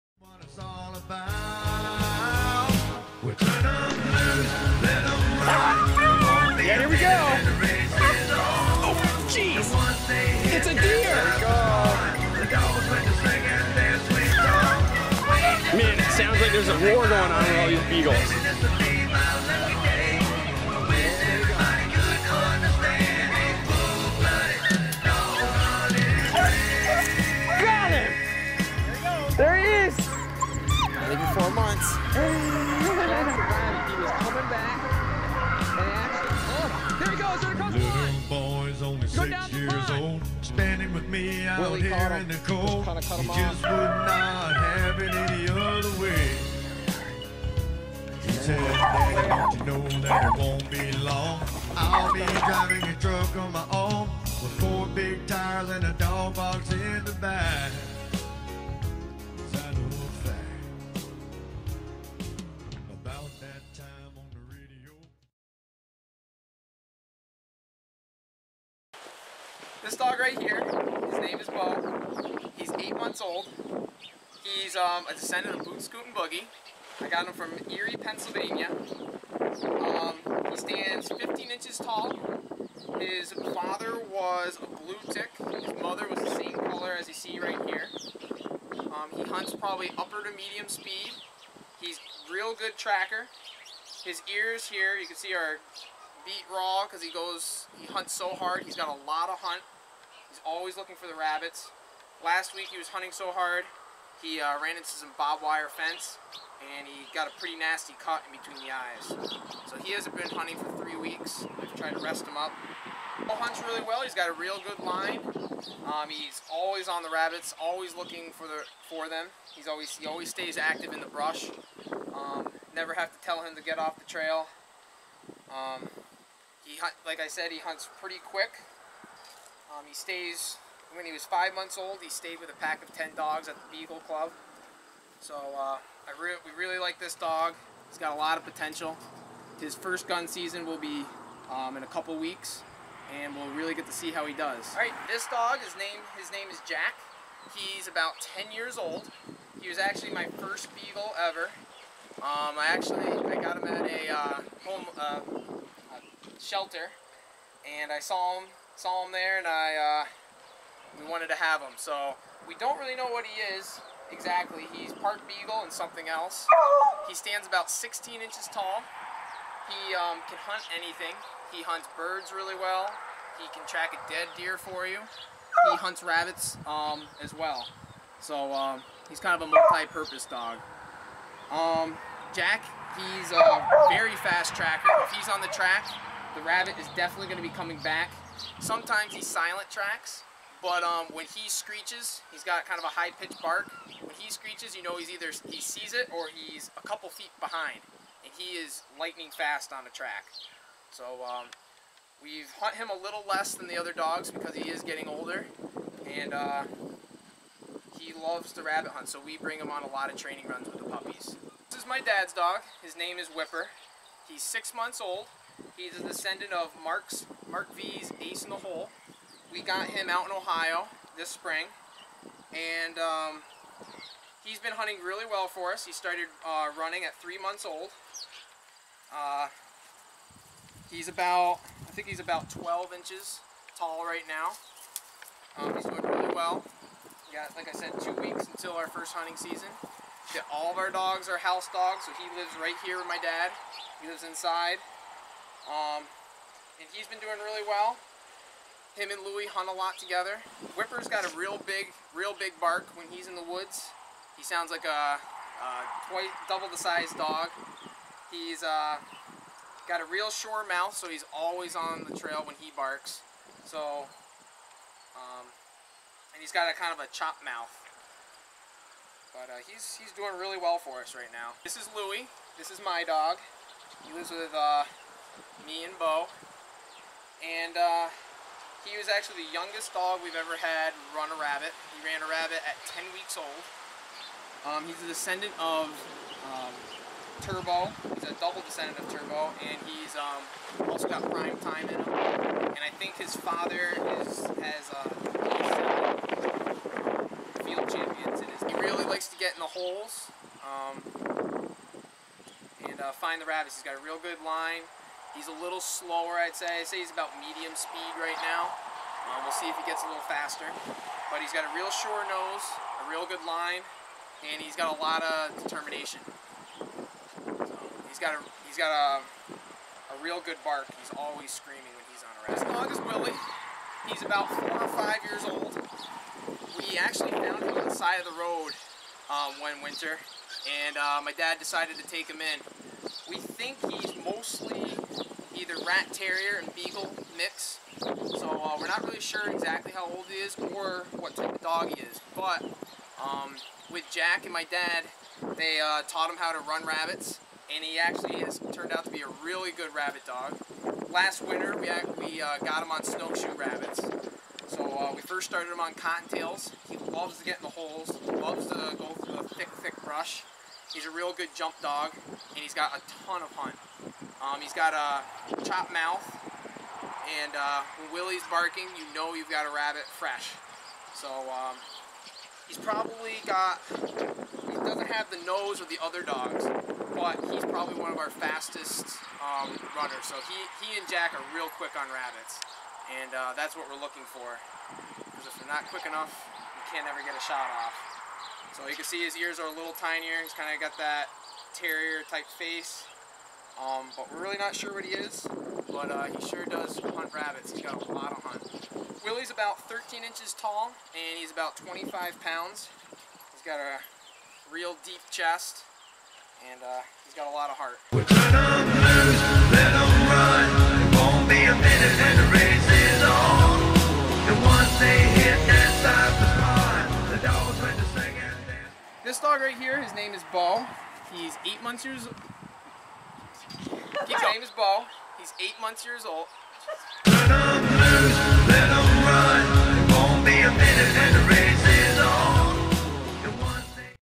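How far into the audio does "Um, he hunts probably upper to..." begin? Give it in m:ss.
1:28.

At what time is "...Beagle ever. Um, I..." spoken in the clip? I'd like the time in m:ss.
2:30.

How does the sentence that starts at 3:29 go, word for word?
So we bring him on a lot of training runs with the puppies.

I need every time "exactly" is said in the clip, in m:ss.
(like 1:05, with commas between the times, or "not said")
2:44, 5:39.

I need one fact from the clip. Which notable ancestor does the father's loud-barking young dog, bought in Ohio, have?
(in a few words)
Mark V's Ace in the Hole.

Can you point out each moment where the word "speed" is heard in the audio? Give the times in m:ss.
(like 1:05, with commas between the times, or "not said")
1:30, 5:07.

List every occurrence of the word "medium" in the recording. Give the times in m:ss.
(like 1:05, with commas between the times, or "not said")
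1:30, 5:07.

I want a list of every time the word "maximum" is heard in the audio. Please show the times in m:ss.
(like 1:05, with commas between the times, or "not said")
not said.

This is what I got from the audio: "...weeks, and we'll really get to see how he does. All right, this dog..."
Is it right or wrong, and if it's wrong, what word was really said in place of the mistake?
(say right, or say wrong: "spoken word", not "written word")
right.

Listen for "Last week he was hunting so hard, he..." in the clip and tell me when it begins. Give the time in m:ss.
1:42.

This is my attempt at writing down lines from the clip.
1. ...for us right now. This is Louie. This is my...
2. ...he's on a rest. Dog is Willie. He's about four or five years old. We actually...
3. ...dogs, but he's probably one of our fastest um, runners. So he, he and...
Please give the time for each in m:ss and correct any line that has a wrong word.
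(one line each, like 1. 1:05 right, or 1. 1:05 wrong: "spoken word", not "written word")
1. 4:30 right
2. 5:22 right
3. 6:16 right.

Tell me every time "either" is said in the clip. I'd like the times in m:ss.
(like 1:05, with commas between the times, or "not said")
3:15, 5:35.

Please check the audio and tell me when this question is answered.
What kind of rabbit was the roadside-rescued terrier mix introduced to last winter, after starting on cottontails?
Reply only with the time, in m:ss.
5:53.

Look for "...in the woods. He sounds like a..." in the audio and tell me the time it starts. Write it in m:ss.
4:13.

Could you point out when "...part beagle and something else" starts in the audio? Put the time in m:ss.
2:44.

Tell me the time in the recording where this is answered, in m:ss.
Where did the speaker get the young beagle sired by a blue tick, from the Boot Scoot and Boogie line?
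1:17.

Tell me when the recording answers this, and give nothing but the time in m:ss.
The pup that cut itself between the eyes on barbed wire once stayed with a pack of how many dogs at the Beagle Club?
2:12.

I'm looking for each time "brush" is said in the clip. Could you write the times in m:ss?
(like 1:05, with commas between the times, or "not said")
2:01, 6:00.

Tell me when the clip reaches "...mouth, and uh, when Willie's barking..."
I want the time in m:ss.
6:05.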